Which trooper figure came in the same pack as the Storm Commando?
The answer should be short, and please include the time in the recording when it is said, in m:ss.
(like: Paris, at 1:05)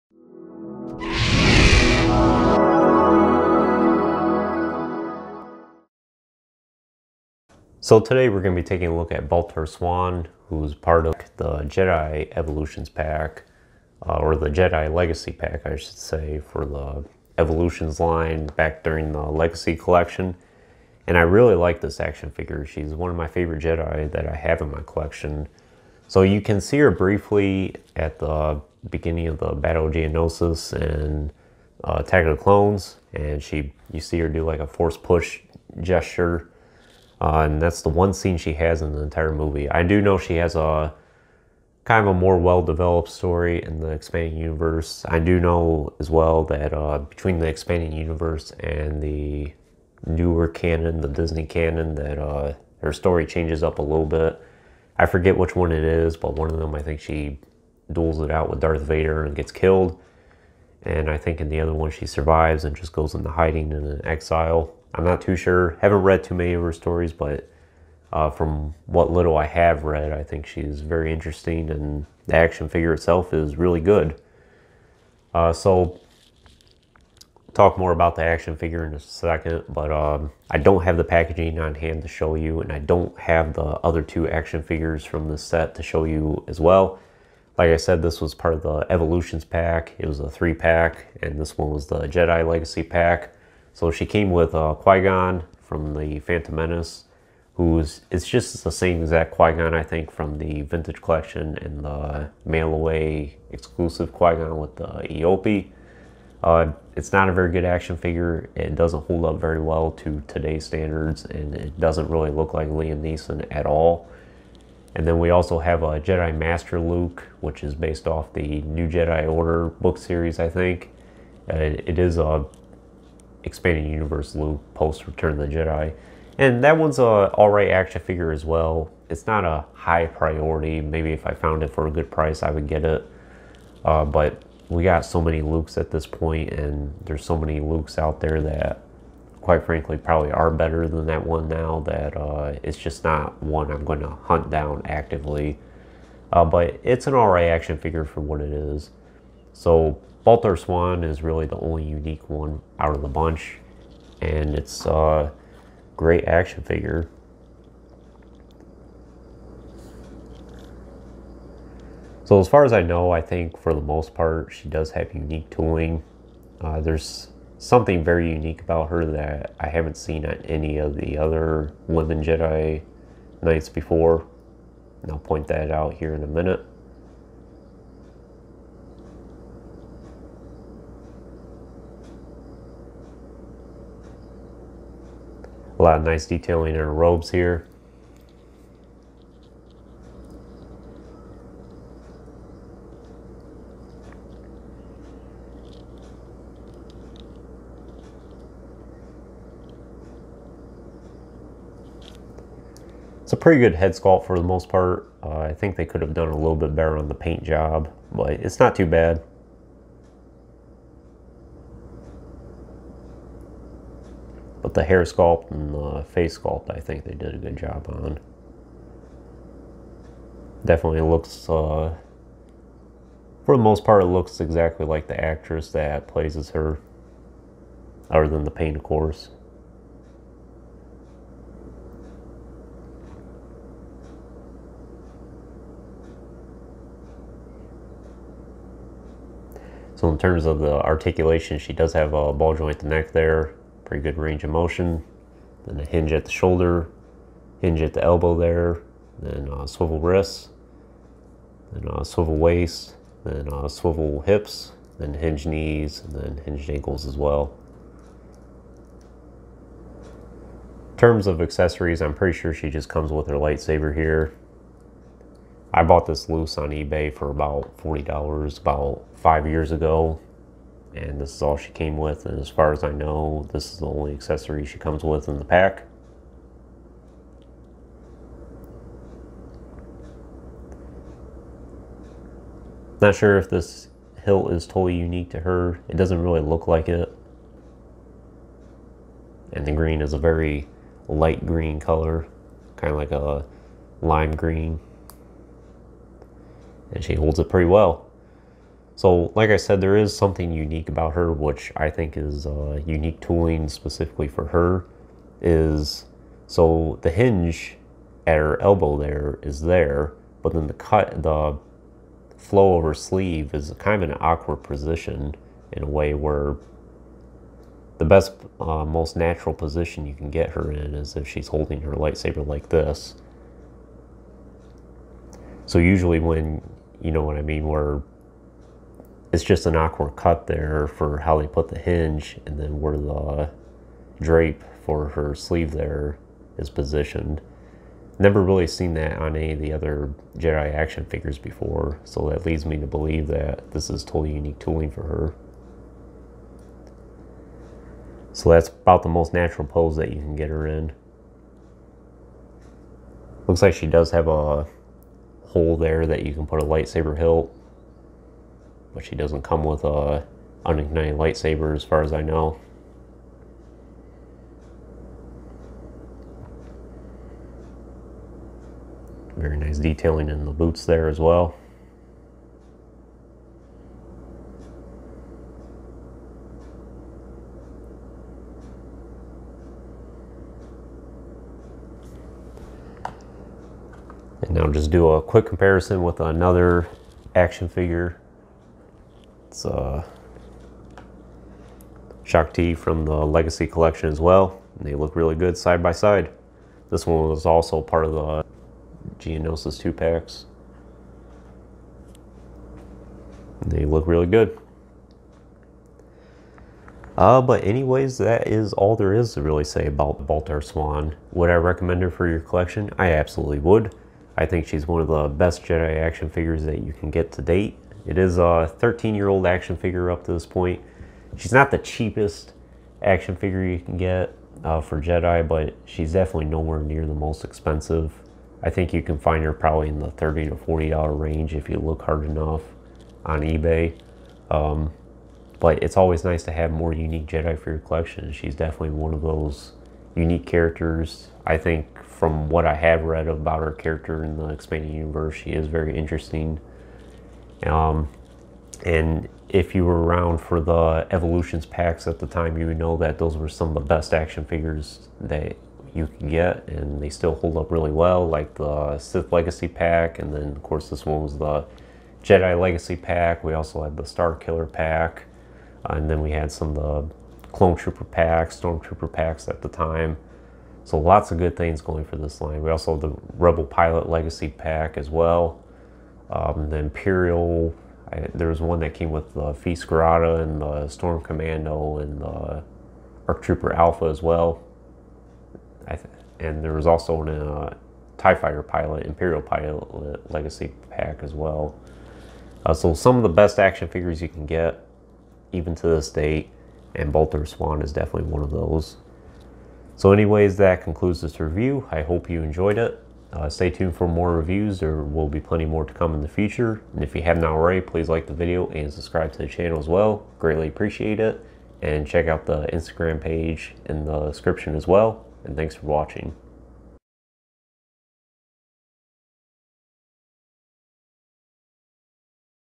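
Arc Trooper Alpha, at 8:03.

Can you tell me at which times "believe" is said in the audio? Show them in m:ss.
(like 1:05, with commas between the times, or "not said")
5:42.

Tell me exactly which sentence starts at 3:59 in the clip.
So in terms of the articulation, she does have a ball joint the neck there.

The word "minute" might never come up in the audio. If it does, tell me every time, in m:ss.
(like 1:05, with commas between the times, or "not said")
2:56.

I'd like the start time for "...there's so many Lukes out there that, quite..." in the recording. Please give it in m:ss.
2:17.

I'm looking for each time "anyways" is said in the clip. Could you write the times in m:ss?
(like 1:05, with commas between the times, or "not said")
6:47, 8:20.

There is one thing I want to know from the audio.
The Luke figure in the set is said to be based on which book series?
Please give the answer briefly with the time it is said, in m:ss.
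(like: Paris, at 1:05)
New Jedi Order, at 1:58.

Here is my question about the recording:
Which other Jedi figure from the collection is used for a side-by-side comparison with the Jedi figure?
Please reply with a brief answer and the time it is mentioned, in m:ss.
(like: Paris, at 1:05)
Shaak Ti, at 6:32.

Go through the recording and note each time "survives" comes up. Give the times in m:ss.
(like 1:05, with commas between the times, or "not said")
1:02.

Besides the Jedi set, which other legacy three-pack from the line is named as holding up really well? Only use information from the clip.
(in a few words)
Sith Legacy pack.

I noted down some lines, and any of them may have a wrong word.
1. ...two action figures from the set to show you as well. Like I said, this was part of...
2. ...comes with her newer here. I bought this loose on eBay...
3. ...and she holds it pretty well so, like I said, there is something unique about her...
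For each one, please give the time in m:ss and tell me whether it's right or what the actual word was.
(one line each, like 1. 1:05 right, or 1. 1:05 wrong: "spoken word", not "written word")
1. 1:24 right
2. 4:22 wrong: "lightsaber", not "newer"
3. 4:56 right.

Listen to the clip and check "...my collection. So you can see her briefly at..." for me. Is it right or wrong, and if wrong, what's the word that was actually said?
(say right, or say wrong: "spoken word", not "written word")
right.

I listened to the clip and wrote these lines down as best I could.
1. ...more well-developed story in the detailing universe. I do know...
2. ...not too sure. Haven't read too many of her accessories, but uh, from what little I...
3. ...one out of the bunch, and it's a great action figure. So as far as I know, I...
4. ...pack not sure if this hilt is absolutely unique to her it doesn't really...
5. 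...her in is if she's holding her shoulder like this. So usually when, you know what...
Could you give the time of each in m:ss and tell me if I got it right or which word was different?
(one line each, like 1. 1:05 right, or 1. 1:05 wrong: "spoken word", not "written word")
1. 0:42 wrong: "expanding", not "detailing"
2. 1:05 wrong: "stories", not "accessories"
3. 2:32 right
4. 4:35 wrong: "totally", not "absolutely"
5. 5:20 wrong: "lightsaber", not "shoulder".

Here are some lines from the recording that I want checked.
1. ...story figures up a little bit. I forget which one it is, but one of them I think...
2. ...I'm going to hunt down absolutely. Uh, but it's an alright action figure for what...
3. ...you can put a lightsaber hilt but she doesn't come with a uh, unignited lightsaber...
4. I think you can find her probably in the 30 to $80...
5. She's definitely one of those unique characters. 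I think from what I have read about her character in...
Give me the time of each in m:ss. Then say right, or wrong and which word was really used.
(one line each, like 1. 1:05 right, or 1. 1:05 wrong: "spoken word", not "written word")
1. 0:52 wrong: "changes", not "figures"
2. 2:23 wrong: "actively", not "absolutely"
3. 5:56 right
4. 7:08 wrong: "40", not "80"
5. 7:18 right.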